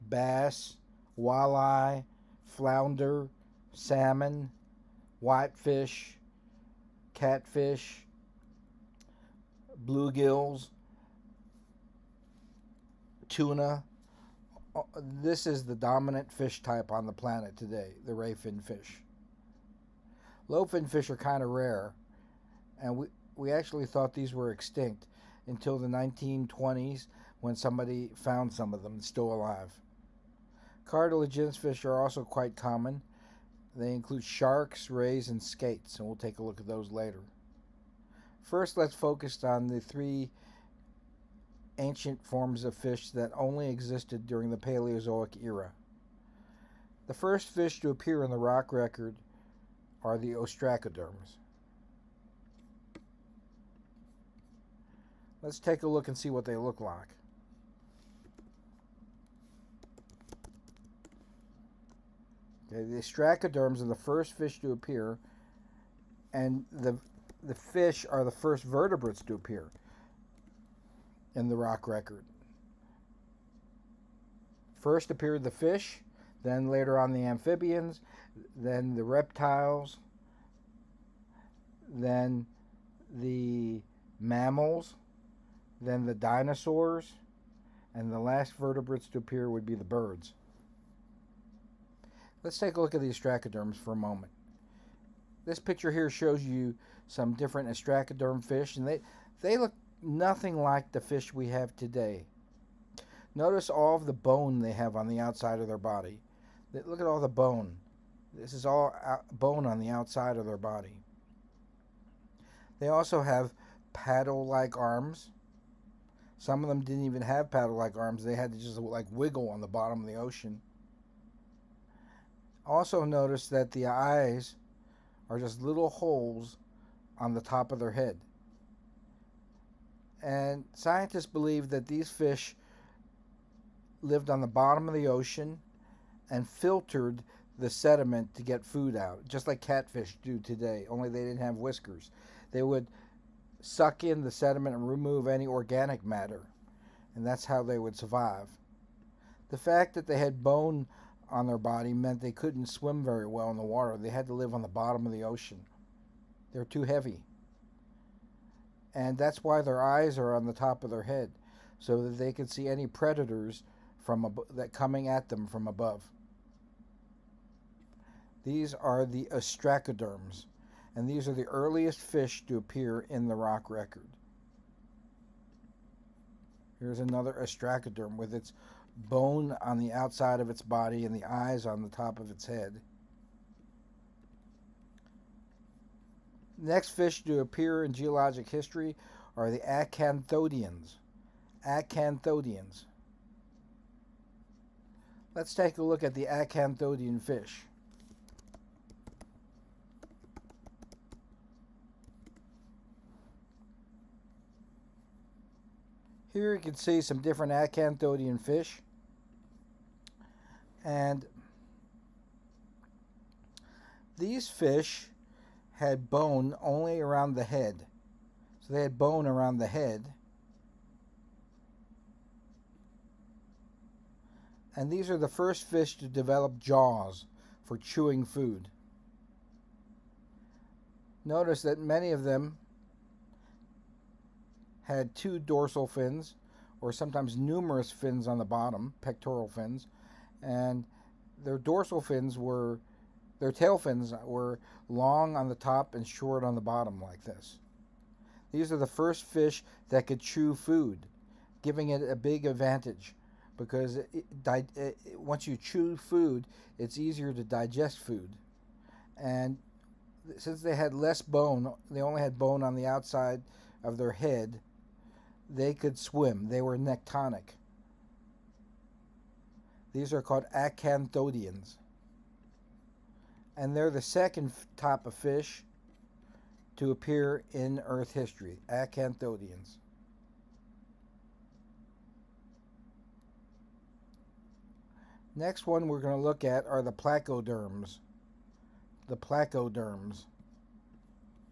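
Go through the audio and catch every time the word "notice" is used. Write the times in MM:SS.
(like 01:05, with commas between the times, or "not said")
01:43, 02:03, 03:51.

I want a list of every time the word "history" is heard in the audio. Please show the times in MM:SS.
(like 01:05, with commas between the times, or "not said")
03:08, 04:38.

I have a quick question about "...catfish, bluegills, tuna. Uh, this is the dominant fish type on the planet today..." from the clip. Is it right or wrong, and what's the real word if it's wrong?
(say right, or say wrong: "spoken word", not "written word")
right.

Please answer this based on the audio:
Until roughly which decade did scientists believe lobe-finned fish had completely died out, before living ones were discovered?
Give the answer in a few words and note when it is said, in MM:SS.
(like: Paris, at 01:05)
1920s, at 00:25.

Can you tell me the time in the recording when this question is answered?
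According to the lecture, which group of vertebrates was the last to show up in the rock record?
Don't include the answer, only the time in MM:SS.
01:29.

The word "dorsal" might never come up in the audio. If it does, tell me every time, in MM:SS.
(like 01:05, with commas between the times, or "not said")
03:55, 04:01.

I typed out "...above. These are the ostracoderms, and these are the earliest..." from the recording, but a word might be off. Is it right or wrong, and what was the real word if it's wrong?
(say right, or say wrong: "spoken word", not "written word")
right.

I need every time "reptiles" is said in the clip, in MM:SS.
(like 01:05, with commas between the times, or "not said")
01:19.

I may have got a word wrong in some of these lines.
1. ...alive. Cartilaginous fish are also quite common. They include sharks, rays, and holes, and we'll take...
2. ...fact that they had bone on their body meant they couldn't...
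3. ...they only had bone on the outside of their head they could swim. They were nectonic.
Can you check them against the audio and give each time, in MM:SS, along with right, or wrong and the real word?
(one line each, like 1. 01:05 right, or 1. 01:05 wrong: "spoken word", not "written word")
1. 00:29 wrong: "skates", not "holes"
2. 02:29 right
3. 04:21 right.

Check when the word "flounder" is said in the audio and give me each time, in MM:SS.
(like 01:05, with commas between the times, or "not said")
00:02.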